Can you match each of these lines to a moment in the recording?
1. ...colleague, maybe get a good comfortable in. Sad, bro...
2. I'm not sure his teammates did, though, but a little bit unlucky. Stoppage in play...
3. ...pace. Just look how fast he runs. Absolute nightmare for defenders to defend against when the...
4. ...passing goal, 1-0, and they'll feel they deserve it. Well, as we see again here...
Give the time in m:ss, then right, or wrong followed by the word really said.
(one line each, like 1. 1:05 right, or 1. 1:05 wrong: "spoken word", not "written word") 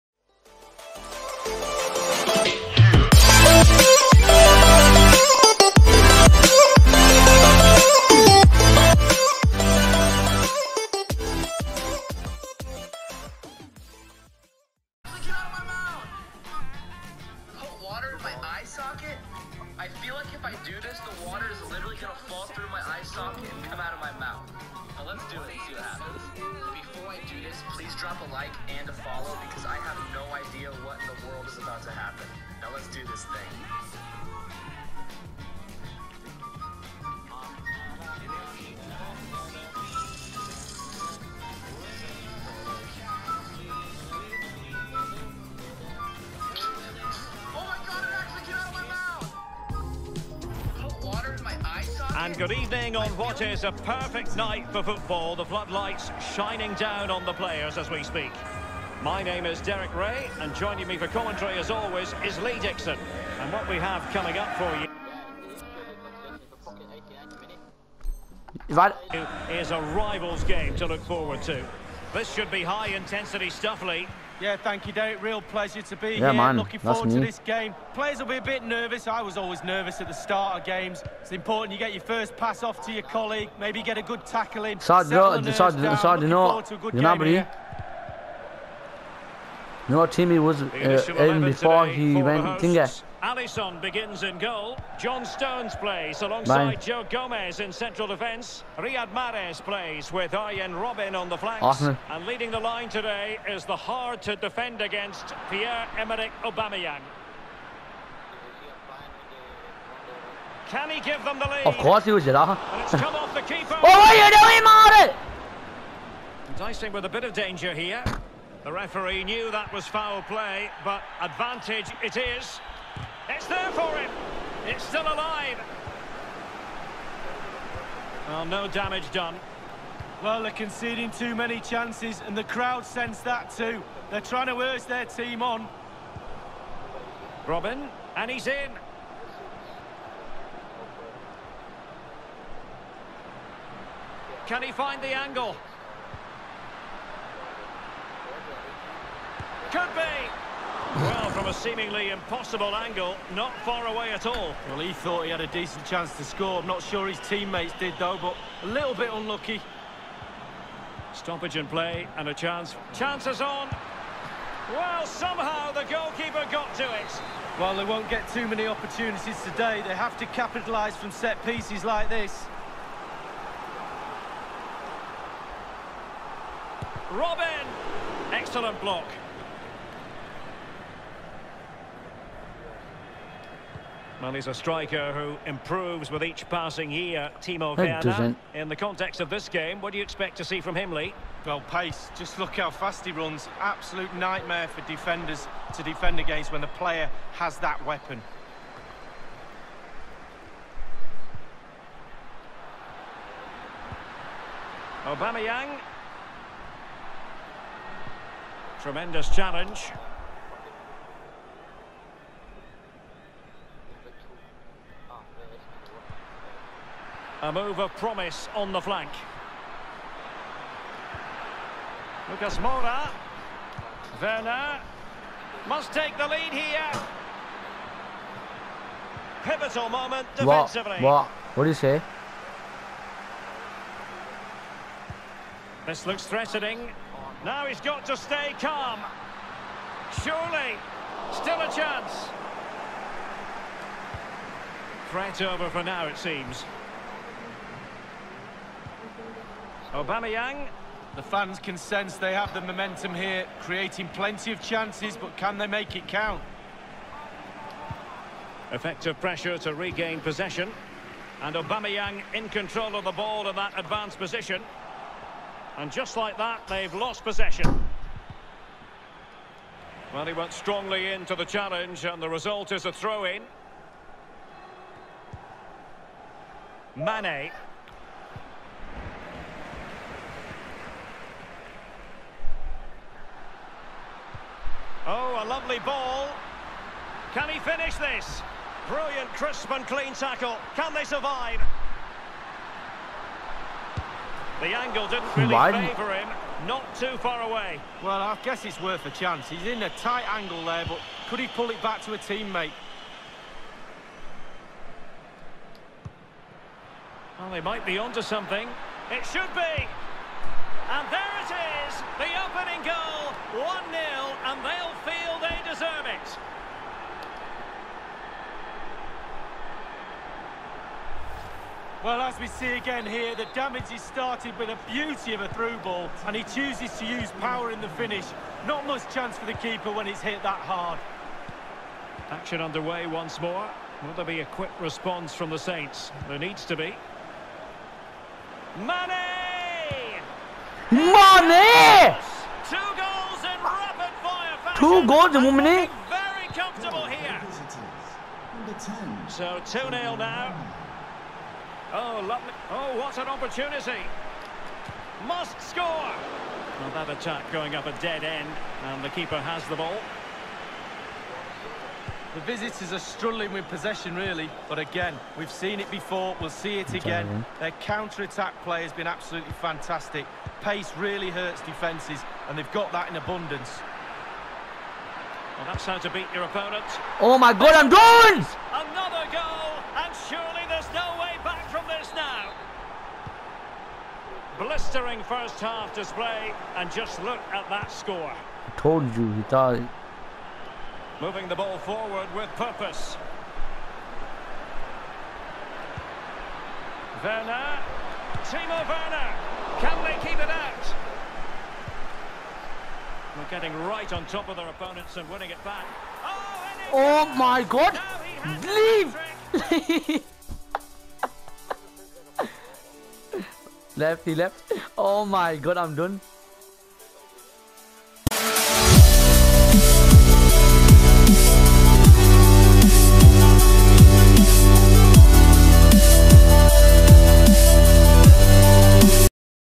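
1. 1:23 wrong: "tackle", not "comfortable"
2. 2:36 right
3. 3:11 right
4. 5:12 wrong: "opening", not "passing".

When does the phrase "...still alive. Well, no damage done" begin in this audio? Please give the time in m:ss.
2:04.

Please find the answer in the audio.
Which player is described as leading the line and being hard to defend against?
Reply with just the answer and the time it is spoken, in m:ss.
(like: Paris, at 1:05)
Pierre-Emerick Aubameyang, at 1:45.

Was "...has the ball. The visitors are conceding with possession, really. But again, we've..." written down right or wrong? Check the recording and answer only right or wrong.
wrong.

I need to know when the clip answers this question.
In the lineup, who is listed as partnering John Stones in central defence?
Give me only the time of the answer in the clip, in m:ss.
1:36.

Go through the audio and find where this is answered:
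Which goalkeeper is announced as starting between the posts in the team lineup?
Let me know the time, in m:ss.
1:33.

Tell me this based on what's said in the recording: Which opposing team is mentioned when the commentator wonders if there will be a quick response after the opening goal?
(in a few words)
Saints.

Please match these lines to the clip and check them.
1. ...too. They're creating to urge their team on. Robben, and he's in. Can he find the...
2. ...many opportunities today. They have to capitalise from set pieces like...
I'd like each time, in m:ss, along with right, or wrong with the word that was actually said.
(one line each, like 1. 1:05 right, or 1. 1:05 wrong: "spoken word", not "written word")
1. 2:13 wrong: "trying", not "creating"
2. 2:48 right.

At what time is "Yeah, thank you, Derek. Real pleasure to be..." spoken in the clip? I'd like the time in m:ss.
1:14.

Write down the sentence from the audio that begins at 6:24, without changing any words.
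Blistering first half display, and just look at that score.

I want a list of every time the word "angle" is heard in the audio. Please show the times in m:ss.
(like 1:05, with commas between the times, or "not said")
2:25, 2:32, 4:54, 5:00.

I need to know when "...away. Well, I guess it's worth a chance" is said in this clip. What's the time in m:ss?
4:57.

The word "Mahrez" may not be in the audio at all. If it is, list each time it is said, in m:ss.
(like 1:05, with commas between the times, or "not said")
1:39, 1:55.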